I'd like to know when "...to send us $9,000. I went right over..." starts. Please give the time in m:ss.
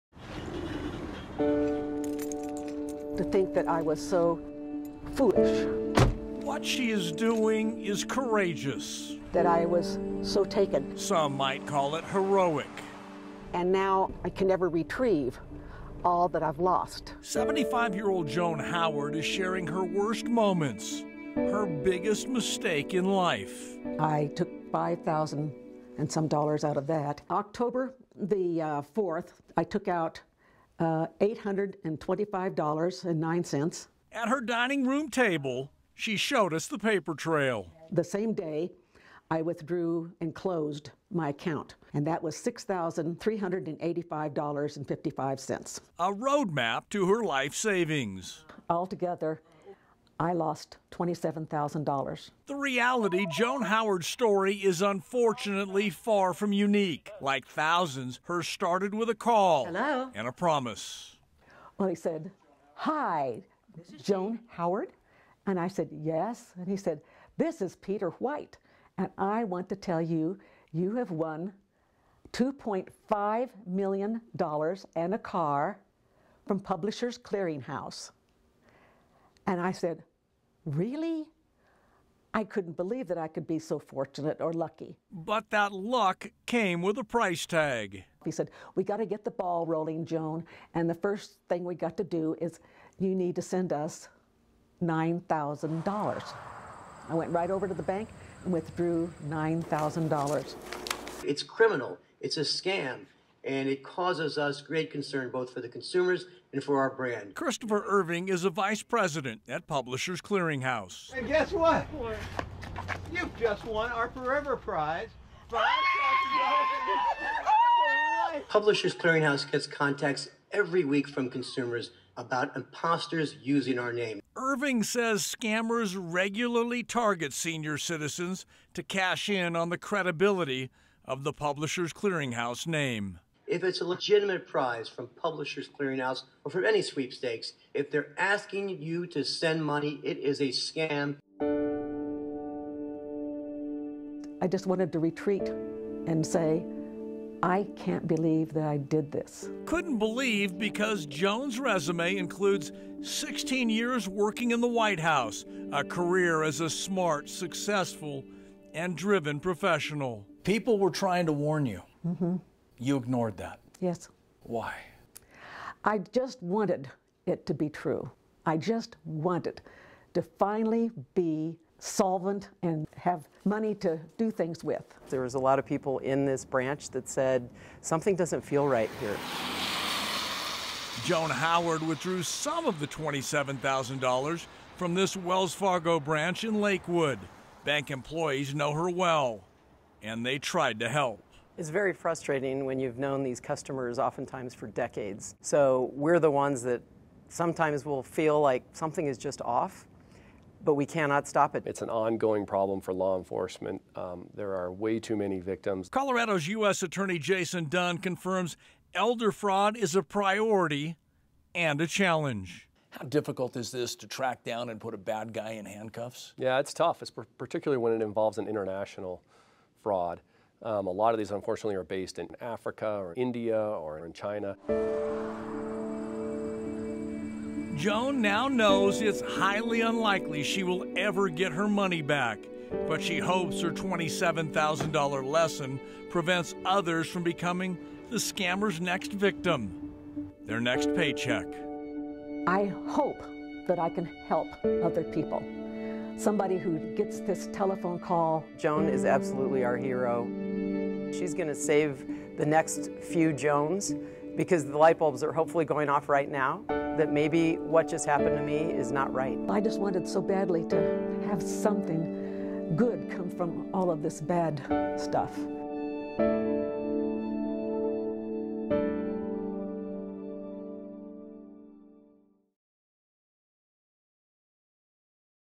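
1:33.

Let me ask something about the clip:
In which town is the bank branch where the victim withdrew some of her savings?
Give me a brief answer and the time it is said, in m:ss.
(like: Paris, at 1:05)
Lakewood, at 3:06.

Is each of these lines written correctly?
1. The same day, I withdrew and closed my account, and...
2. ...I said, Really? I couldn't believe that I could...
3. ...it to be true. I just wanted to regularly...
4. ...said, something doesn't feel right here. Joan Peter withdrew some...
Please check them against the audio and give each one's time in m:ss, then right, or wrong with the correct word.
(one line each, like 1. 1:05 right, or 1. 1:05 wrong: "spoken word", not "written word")
1. 0:37 right
2. 1:19 right
3. 2:47 wrong: "finally", not "regularly"
4. 2:57 wrong: "Howard", not "Peter".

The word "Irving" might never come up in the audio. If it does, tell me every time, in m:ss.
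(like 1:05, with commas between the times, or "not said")
1:47, 2:04.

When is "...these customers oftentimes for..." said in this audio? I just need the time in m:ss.
3:13.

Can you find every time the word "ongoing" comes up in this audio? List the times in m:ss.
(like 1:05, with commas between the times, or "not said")
3:21.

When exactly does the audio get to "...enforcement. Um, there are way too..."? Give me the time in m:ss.
3:23.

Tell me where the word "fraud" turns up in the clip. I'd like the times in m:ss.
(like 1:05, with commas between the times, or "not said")
3:29, 3:39.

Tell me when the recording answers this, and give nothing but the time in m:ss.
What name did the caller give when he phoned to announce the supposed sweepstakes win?
1:07.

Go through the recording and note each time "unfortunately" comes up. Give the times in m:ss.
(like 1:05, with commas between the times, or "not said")
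0:54, 3:41.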